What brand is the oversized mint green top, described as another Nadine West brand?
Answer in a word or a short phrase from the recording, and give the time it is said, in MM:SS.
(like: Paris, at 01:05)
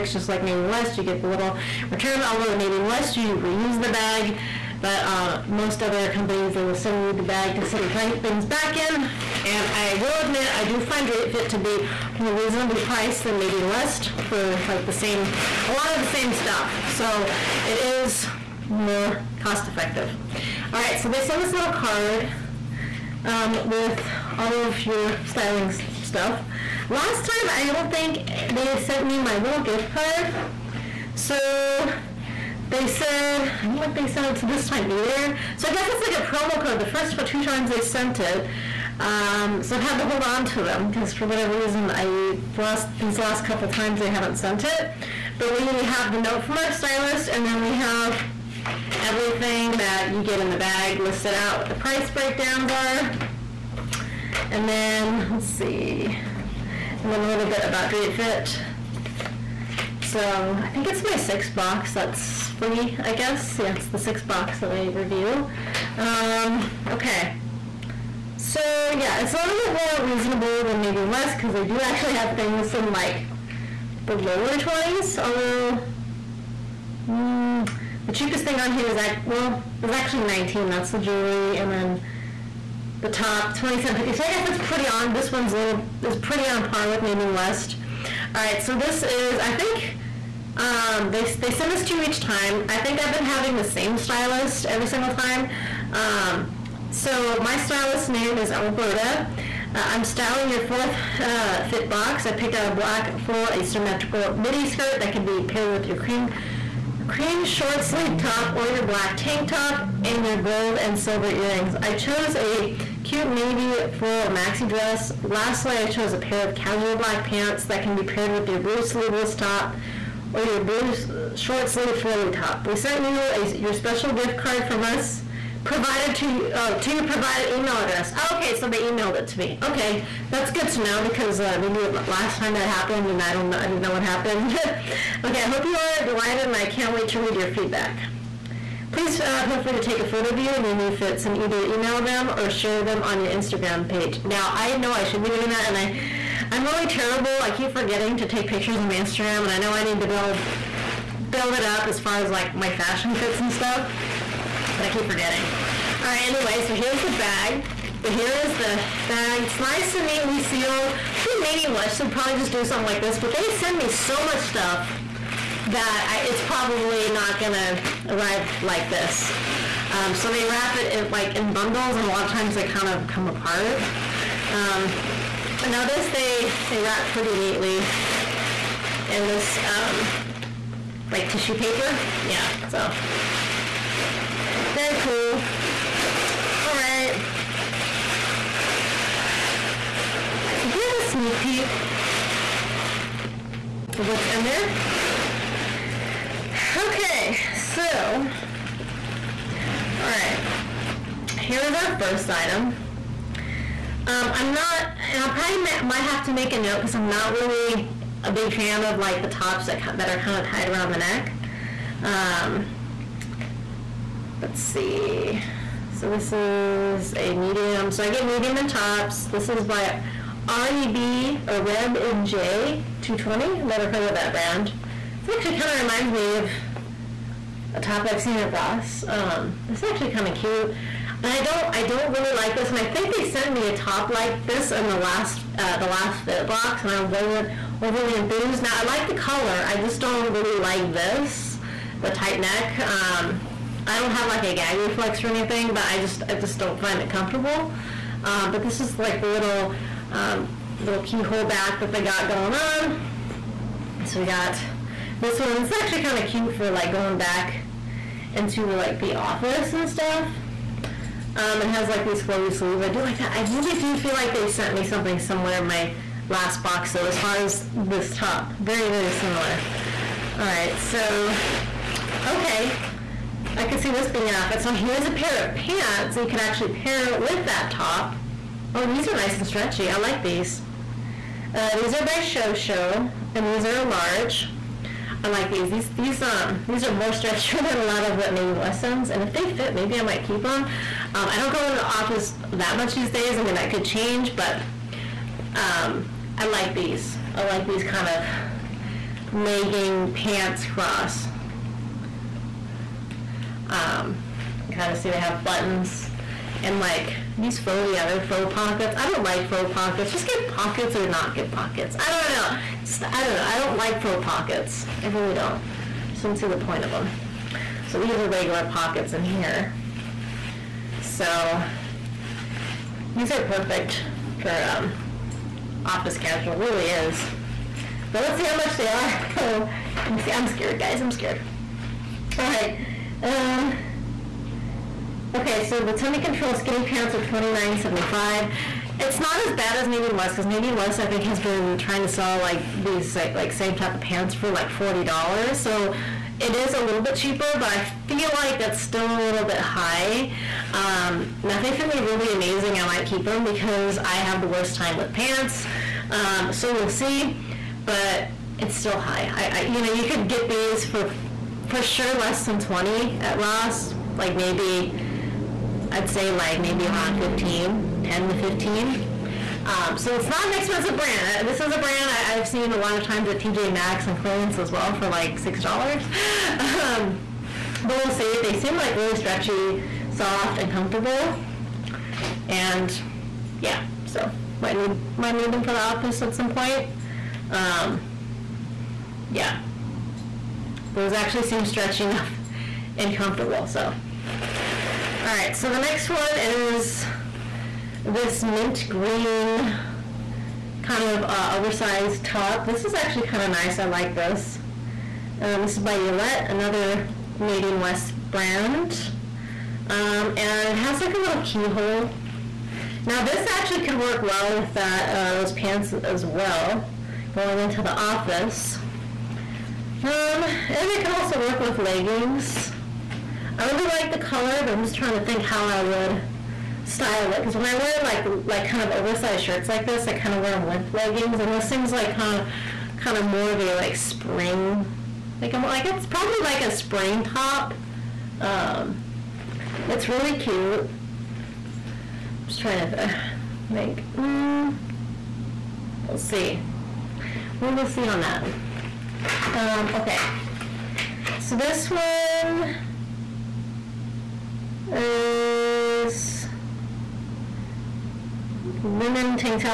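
Yolette, at 06:45.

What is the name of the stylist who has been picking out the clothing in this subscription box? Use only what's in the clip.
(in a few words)
Alberta.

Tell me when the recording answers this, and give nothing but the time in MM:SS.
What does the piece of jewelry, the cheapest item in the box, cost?
01:20.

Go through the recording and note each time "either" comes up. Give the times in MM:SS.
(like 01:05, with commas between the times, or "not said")
00:34, 02:21.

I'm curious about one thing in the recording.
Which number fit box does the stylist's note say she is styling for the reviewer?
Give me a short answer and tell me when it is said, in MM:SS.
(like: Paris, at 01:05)
fourth, at 01:40.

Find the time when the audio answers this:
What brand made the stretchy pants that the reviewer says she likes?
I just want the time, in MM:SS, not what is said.
04:42.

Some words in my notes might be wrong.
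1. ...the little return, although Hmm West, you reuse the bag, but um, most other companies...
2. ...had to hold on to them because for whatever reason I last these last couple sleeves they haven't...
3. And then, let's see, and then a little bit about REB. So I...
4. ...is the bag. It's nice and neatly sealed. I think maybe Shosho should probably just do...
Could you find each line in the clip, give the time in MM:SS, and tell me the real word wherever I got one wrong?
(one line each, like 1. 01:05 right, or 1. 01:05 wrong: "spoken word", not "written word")
1. 00:01 wrong: "Nadine", not "Hmm"
2. 00:39 wrong: "times", not "sleeves"
3. 00:54 wrong: "Drapefit", not "REB"
4. 02:38 wrong: "West", not "Shosho".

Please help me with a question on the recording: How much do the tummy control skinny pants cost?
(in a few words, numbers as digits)
$29.75.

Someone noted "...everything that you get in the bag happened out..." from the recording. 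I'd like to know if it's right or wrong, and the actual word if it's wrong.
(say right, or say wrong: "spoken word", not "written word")
wrong: "listed", not "happened".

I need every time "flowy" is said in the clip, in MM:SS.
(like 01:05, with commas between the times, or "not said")
02:01, 04:22.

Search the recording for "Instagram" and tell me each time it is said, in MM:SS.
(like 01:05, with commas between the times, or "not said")
02:23, 02:28.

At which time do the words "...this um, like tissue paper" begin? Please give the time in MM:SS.
02:59.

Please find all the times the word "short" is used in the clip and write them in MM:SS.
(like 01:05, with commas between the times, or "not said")
01:47, 02:01.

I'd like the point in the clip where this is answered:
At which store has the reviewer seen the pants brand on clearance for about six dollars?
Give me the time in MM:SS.
06:13.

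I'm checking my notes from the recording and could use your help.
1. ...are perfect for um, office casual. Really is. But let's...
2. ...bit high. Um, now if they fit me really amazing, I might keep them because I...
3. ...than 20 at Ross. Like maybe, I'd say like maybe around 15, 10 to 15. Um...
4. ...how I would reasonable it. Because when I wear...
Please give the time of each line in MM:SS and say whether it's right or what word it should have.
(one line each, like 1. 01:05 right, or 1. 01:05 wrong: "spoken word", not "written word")
1. 05:23 right
2. 05:49 right
3. 06:02 right
4. 07:05 wrong: "style", not "reasonable".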